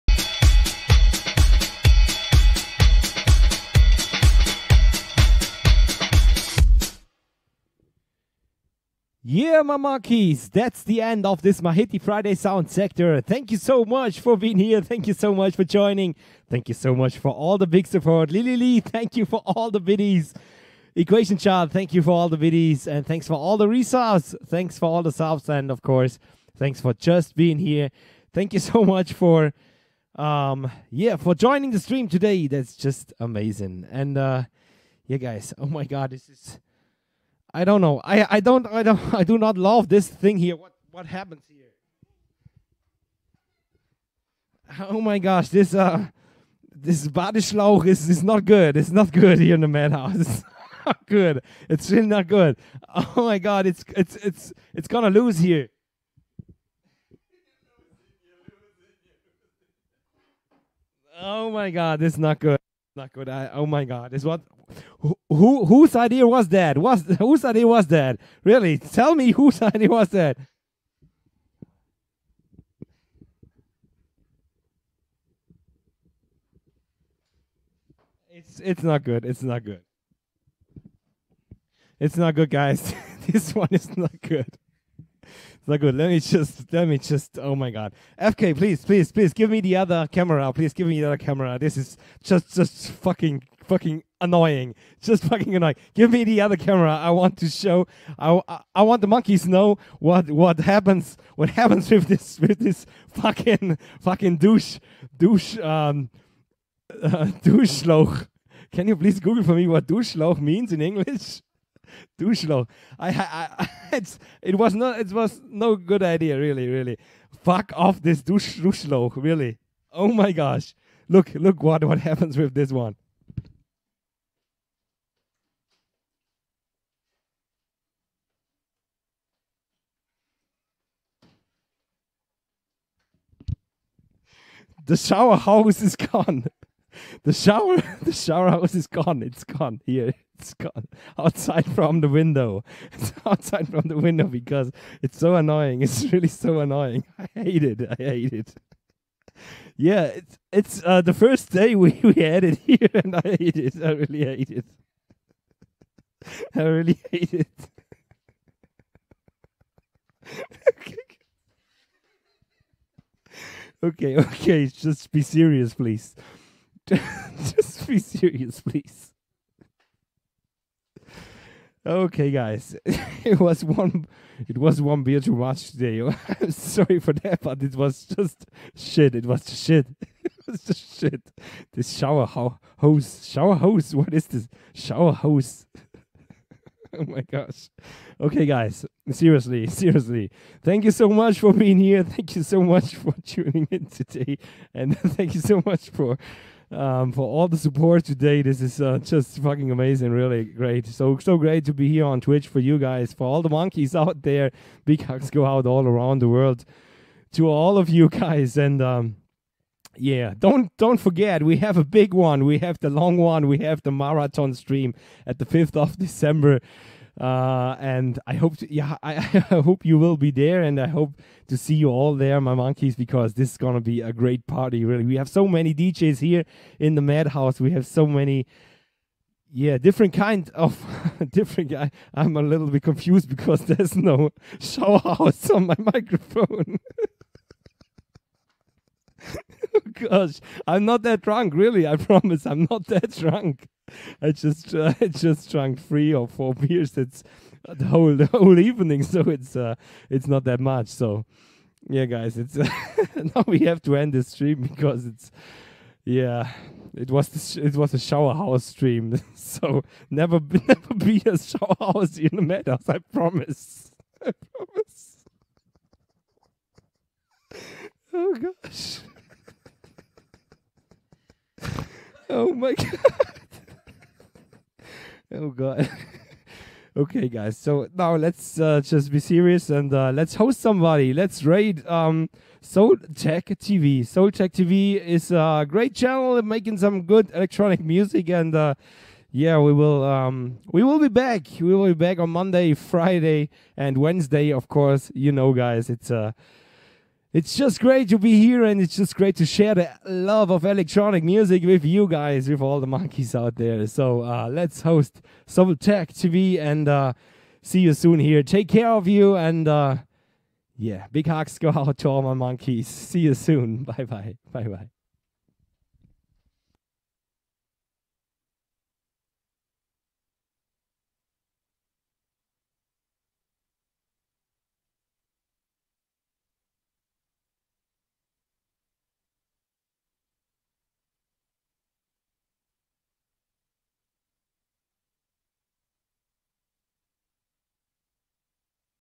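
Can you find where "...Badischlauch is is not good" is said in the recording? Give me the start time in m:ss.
0:47.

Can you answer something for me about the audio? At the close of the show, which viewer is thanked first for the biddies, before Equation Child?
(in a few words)
Lily Lee.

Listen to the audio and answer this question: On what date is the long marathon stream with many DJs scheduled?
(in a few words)
5 December.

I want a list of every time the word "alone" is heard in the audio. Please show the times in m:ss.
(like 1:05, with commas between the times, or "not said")
not said.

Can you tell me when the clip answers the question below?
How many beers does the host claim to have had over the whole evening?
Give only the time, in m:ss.
4:05.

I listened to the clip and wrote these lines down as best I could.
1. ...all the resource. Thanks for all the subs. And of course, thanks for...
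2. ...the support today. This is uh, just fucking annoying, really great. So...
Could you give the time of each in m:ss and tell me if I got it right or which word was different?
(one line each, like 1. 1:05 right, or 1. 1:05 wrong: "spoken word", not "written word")
1. 0:23 right
2. 3:17 wrong: "amazing", not "annoying".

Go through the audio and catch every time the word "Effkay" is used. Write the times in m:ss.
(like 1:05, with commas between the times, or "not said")
1:28.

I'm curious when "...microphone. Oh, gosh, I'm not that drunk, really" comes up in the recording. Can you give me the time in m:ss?
3:55.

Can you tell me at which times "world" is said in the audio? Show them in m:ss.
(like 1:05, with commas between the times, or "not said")
3:26.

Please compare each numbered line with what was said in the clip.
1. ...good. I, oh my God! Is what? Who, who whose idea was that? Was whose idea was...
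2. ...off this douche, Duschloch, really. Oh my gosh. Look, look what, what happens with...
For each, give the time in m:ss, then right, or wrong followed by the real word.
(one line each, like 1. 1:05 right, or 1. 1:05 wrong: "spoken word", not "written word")
1. 1:03 right
2. 1:57 right.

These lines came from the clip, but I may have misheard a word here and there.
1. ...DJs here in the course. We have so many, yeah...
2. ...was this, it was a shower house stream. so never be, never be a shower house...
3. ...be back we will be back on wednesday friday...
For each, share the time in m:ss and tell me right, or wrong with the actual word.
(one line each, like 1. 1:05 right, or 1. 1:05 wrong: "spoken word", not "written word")
1. 3:45 wrong: "madhouse", not "course"
2. 4:17 right
3. 4:50 wrong: "monday", not "wednesday".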